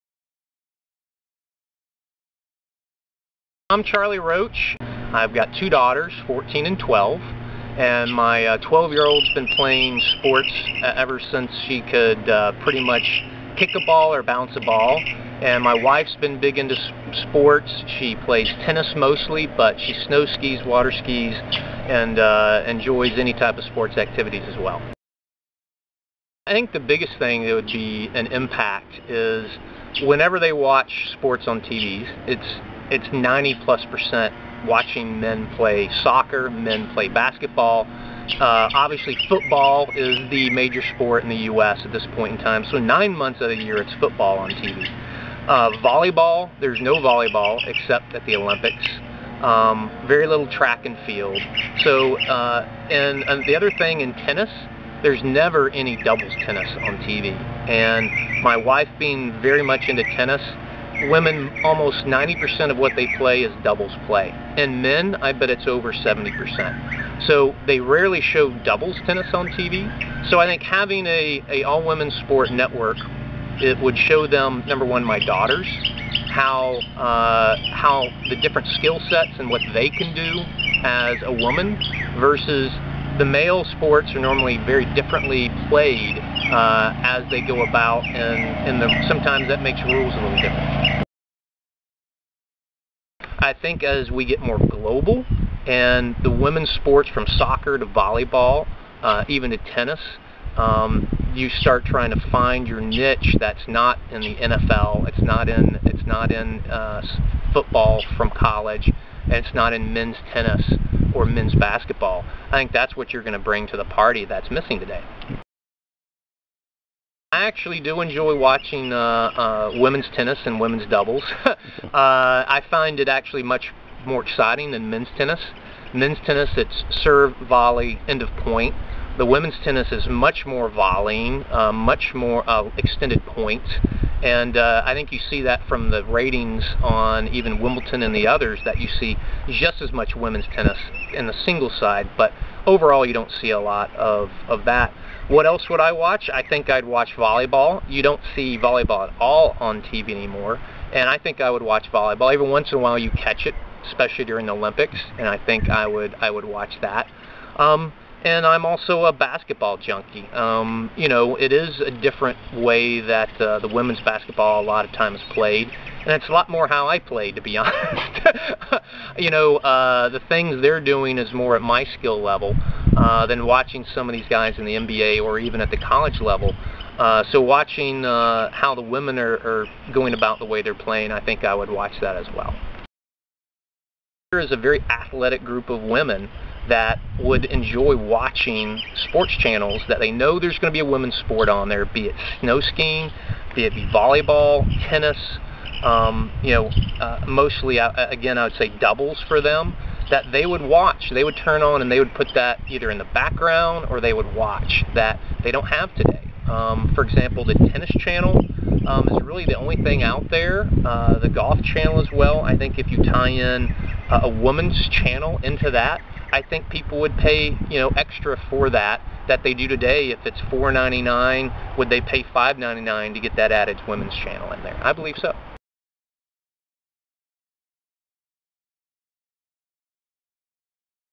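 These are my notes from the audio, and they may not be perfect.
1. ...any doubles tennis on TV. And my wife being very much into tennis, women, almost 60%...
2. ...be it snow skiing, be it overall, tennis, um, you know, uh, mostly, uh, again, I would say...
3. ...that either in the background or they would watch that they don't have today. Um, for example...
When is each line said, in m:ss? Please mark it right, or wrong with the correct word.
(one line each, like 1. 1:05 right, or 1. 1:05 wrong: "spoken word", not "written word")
1. 0:55 wrong: "90", not "60"
2. 3:11 wrong: "volleyball", not "overall"
3. 3:22 right.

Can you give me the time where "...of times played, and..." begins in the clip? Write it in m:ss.
2:44.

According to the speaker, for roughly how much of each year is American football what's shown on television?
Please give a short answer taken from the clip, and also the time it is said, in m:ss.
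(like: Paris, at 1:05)
9 months, at 0:42.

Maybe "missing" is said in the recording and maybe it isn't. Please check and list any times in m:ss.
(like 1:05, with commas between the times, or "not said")
1:54.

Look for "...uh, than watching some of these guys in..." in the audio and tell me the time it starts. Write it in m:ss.
2:52.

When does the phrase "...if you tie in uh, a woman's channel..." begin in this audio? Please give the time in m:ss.
3:32.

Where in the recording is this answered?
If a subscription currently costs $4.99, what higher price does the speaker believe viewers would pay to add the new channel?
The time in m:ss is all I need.
3:42.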